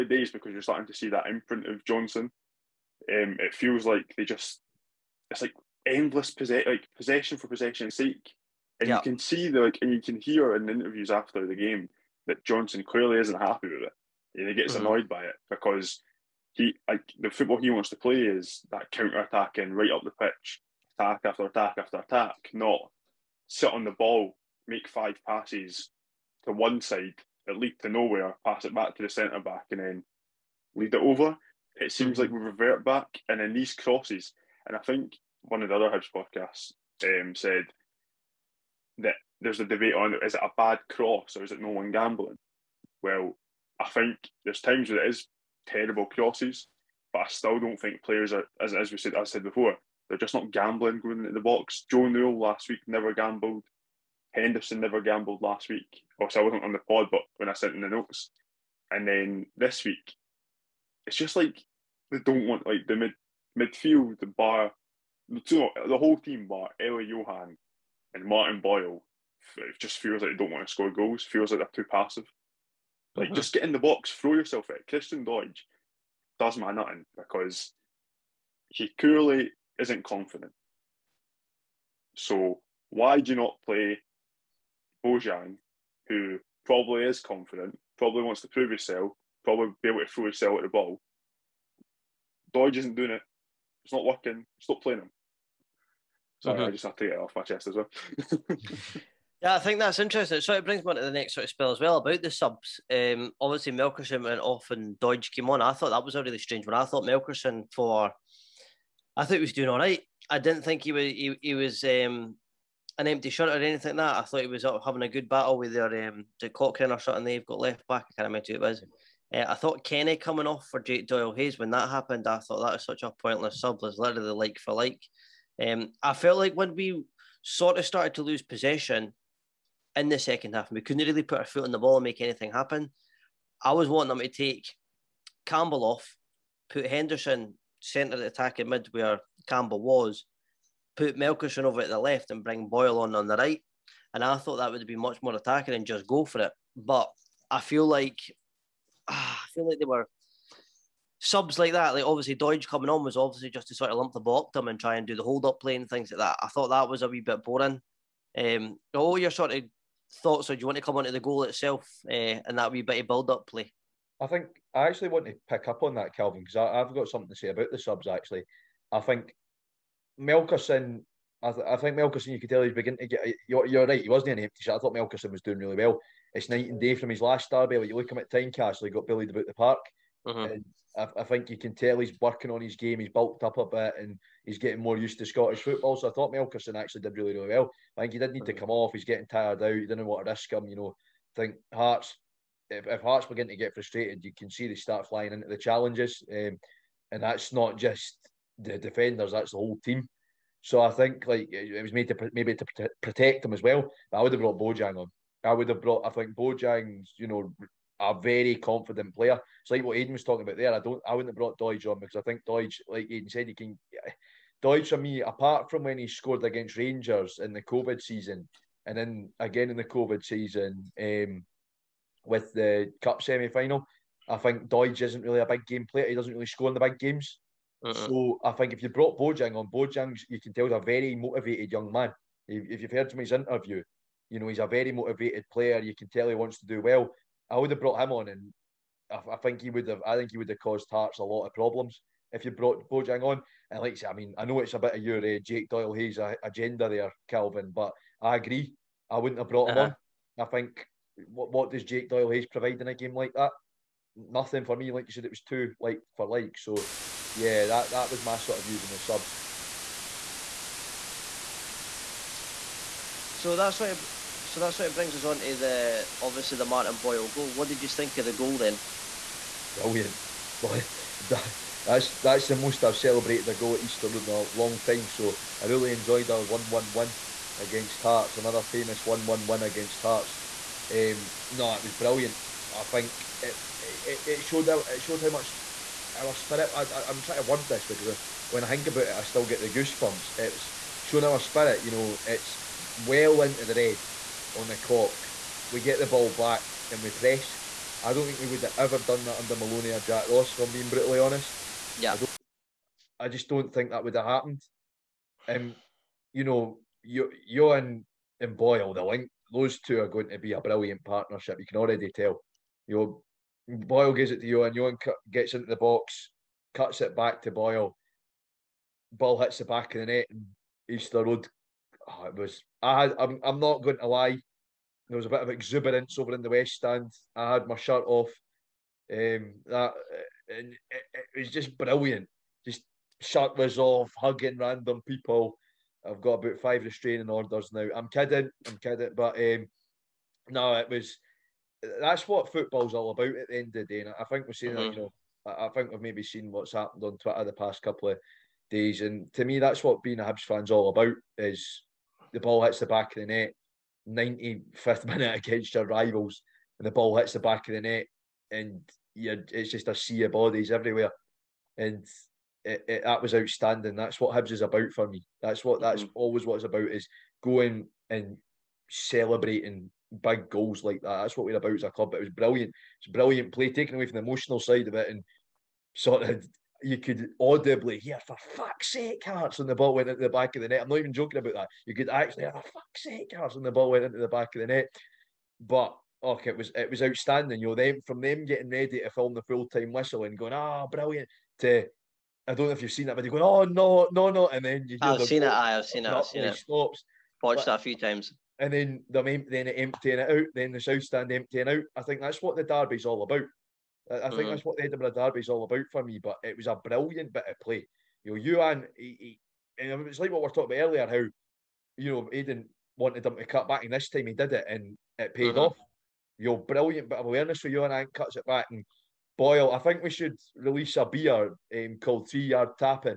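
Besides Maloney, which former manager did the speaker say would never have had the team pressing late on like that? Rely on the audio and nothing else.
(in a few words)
Jack Ross.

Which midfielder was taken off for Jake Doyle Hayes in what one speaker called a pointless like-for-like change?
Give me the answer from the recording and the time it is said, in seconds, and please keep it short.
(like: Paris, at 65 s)
Kenneh, at 119 s.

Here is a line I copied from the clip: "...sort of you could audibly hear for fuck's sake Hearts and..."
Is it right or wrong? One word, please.
right.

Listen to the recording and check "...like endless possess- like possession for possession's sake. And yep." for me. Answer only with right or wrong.
right.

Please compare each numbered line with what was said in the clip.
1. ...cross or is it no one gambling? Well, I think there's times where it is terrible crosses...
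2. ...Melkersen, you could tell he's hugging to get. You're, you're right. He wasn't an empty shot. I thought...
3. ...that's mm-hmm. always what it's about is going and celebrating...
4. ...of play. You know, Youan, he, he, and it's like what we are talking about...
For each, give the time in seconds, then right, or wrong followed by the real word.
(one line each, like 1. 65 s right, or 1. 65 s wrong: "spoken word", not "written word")
1. 40 s right
2. 171 s wrong: "beginning", not "hugging"
3. 365 s right
4. 407 s right.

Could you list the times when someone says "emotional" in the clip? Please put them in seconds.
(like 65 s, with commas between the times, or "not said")
374 s.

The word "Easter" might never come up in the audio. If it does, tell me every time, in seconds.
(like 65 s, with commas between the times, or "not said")
273 s, 320 s.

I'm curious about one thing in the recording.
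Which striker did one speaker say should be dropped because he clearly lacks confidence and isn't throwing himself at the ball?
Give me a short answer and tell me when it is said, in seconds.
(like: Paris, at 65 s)
Christian Doidge, at 74 s.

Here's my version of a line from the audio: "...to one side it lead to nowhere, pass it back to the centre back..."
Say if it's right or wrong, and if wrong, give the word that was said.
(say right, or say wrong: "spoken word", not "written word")
right.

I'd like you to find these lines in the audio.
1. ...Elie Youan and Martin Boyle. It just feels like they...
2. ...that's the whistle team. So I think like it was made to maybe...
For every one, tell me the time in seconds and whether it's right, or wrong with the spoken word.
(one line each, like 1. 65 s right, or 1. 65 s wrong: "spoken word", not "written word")
1. 66 s right
2. 199 s wrong: "whole", not "whistle".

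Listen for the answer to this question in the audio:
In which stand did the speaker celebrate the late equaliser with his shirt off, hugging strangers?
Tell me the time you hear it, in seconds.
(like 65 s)
326 s.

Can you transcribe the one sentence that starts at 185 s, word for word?
So I thought Melkersen actually did really, really well.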